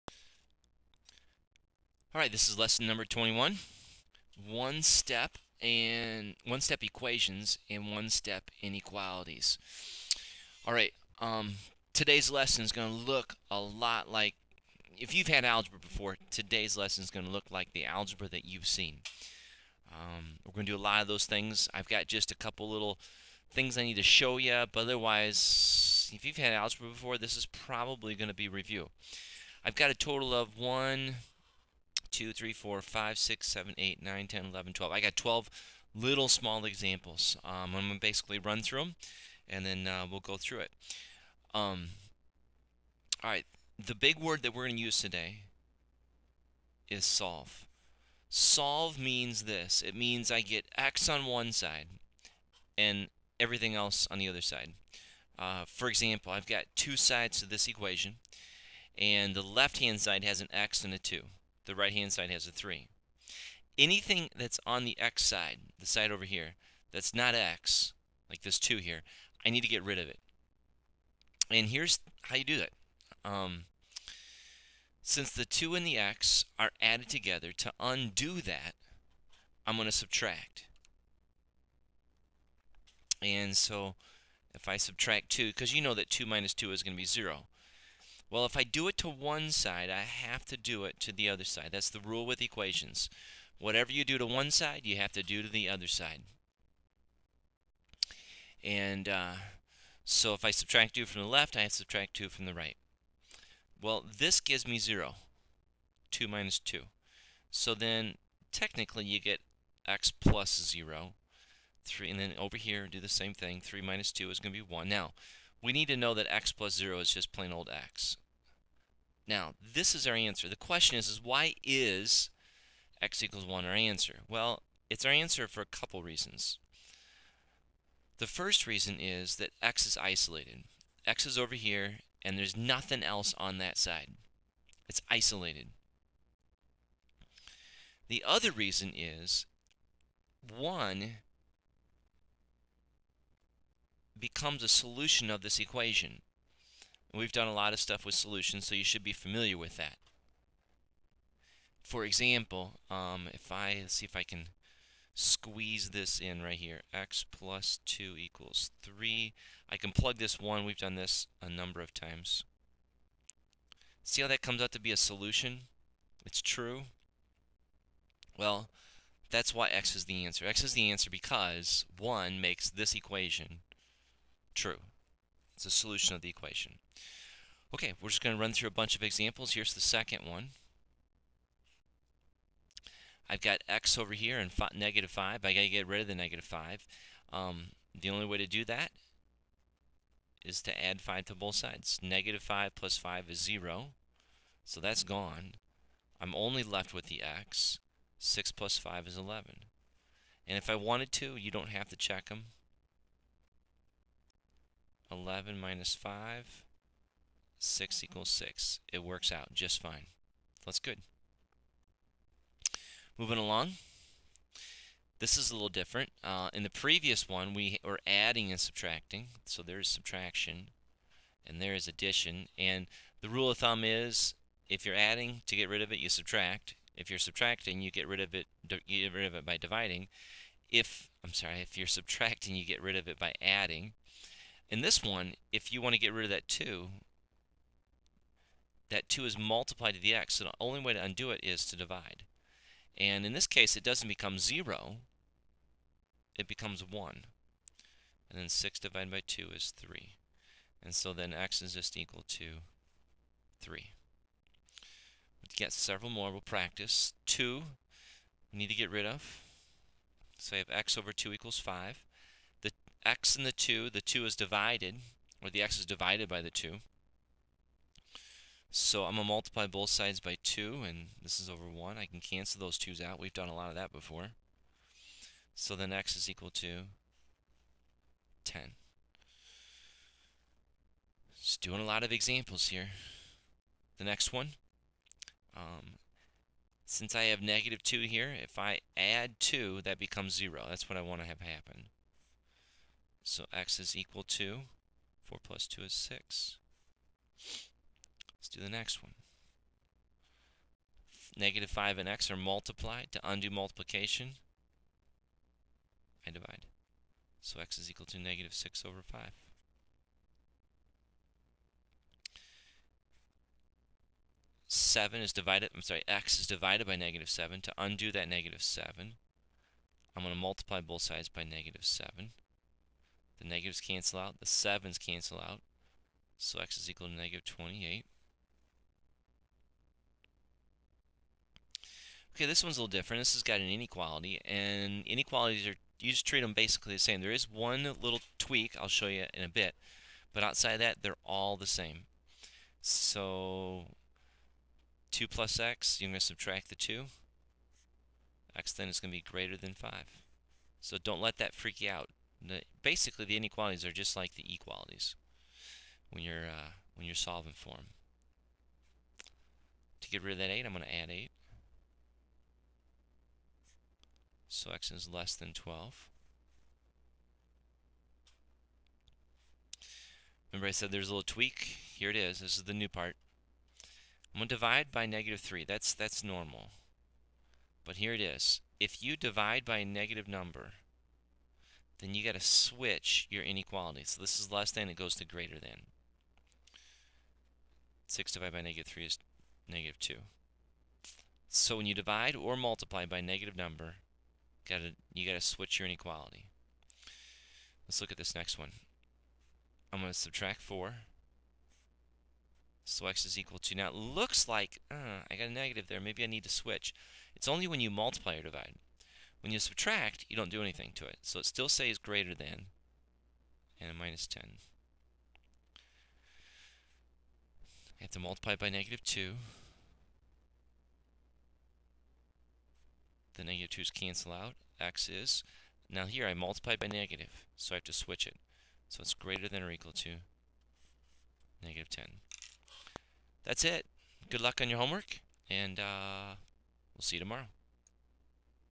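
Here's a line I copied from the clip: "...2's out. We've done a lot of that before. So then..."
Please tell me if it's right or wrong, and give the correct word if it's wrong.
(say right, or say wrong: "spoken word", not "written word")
right.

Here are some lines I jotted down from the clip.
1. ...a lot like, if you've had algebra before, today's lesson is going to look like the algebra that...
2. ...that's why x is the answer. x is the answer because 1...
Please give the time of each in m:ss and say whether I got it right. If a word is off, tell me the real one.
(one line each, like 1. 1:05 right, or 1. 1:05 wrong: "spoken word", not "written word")
1. 0:13 right
2. 2:49 right.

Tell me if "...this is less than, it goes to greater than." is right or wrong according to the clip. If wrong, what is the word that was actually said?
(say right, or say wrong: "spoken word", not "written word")
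right.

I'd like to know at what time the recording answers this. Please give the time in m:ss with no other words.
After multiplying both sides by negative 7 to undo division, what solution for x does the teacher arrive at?
5:26.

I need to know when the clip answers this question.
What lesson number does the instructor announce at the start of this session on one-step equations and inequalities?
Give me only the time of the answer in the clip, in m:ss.
0:02.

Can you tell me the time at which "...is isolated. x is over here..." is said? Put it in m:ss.
2:09.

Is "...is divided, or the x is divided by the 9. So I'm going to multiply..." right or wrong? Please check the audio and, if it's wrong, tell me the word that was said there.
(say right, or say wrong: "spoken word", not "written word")
wrong: "2", not "9".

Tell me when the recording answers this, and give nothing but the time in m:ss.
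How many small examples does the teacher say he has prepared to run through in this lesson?
0:34.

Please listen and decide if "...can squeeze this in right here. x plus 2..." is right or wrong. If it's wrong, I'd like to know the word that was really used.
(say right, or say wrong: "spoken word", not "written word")
right.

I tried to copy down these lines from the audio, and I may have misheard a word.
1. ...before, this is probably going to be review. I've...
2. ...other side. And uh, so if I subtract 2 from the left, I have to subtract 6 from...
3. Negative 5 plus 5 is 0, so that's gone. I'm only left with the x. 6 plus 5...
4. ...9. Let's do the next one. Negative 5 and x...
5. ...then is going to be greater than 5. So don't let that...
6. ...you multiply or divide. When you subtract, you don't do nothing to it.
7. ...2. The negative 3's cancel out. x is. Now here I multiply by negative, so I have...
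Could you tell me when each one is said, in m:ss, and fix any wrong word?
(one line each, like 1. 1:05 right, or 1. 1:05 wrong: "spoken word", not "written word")
1. 0:26 right
2. 1:35 wrong: "2", not "6"
3. 3:12 right
4. 4:55 wrong: "6", not "9"
5. 5:48 right
6. 6:47 wrong: "anything", not "nothing"
7. 6:59 wrong: "2", not "3".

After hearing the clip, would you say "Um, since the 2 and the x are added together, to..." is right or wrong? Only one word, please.
right.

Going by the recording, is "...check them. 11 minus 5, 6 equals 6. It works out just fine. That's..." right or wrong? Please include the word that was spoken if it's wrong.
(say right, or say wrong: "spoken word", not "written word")
right.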